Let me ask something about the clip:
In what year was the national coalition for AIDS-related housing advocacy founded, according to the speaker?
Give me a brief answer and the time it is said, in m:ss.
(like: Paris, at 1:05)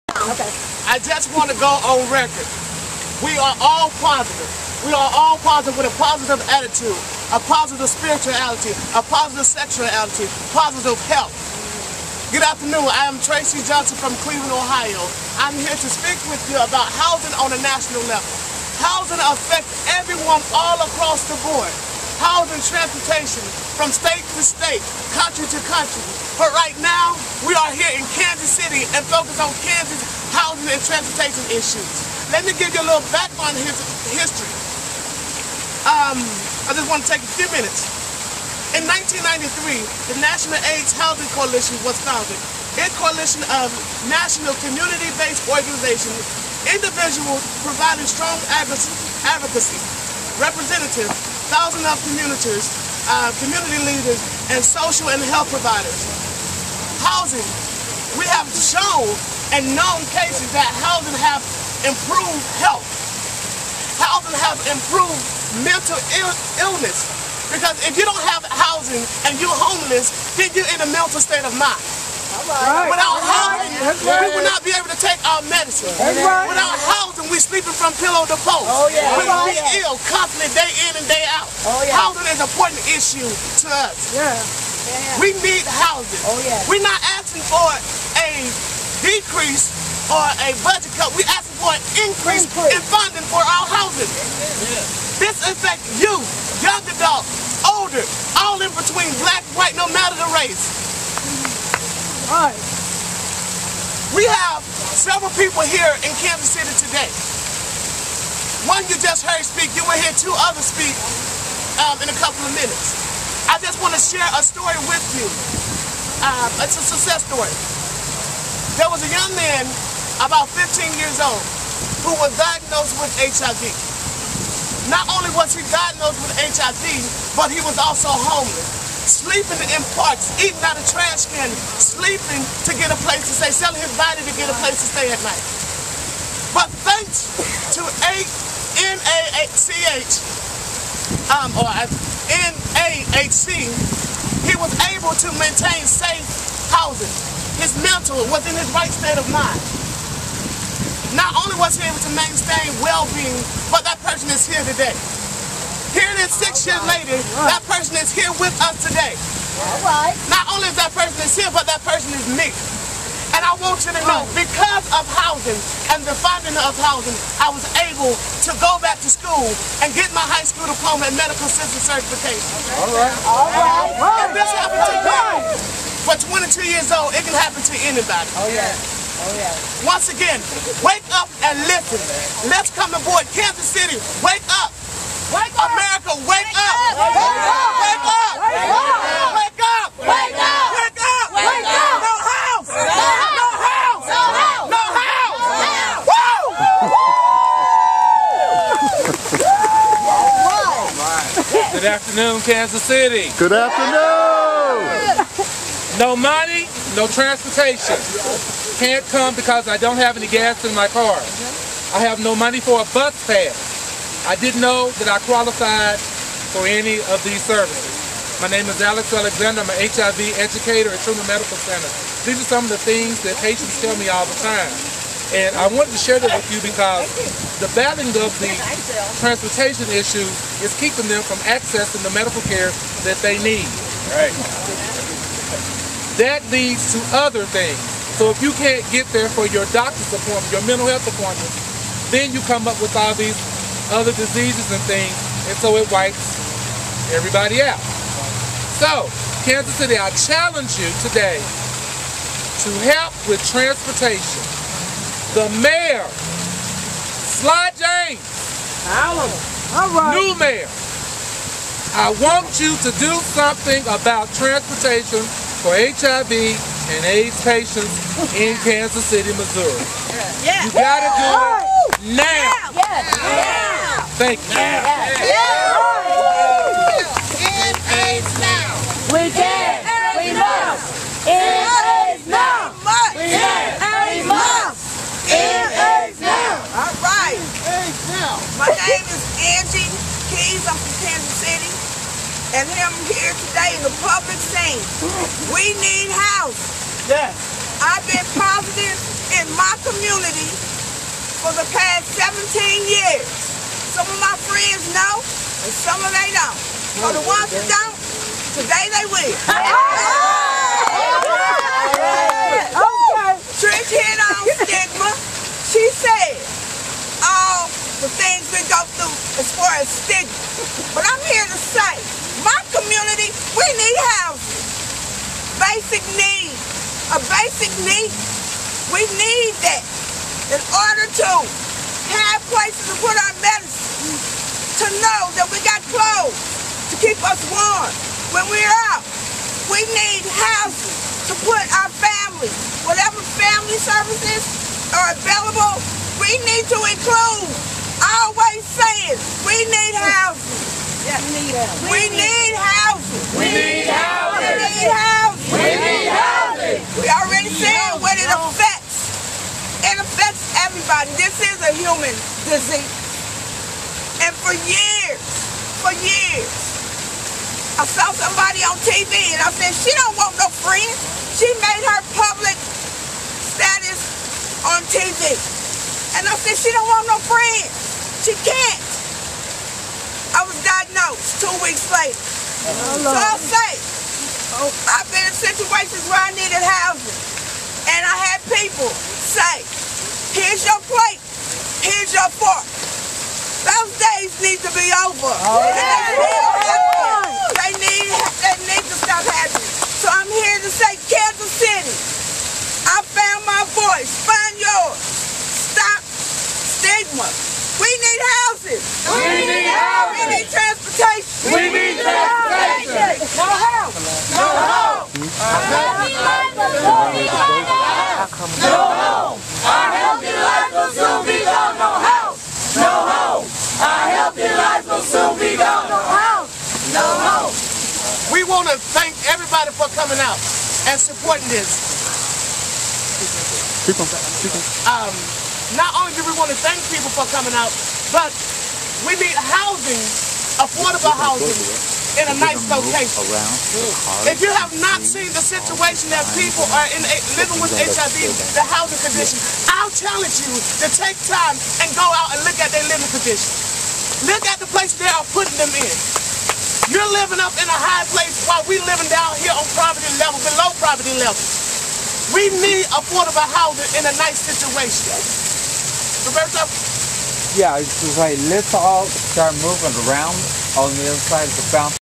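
1993, at 0:38.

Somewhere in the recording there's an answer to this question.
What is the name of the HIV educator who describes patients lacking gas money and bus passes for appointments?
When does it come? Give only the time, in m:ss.
3:38.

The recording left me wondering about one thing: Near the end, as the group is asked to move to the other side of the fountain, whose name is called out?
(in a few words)
Roberto.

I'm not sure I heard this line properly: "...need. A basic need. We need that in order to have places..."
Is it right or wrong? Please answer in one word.
right.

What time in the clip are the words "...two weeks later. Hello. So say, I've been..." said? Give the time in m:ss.
6:21.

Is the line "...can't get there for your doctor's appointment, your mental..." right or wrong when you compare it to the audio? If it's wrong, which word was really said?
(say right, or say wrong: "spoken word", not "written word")
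right.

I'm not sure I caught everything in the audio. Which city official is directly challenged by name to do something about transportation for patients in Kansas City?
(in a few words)
Sly James.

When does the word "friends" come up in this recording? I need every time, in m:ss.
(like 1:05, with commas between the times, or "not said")
5:04, 6:10, 6:17.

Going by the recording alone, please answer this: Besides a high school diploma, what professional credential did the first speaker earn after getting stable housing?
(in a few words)
Medical assistant certification.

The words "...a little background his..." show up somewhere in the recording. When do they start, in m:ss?
0:32.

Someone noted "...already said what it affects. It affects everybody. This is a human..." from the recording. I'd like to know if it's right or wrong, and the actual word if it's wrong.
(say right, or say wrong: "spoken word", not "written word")
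right.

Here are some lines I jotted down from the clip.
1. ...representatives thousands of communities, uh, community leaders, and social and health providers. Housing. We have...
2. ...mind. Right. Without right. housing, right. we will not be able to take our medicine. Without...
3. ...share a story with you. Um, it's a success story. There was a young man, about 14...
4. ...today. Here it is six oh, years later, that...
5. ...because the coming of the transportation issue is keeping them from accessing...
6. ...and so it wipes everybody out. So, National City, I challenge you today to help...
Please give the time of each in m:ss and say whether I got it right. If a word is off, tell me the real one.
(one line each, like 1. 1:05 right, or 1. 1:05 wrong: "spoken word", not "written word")
1. 0:50 right
2. 1:11 right
3. 1:54 wrong: "15", not "14"
4. 2:34 right
5. 3:46 wrong: "battling", not "coming"
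6. 4:05 wrong: "Kansas", not "National".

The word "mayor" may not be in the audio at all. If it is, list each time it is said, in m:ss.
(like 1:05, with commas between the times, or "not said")
4:15, 4:20.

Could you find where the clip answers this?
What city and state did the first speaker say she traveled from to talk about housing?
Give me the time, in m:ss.
0:14.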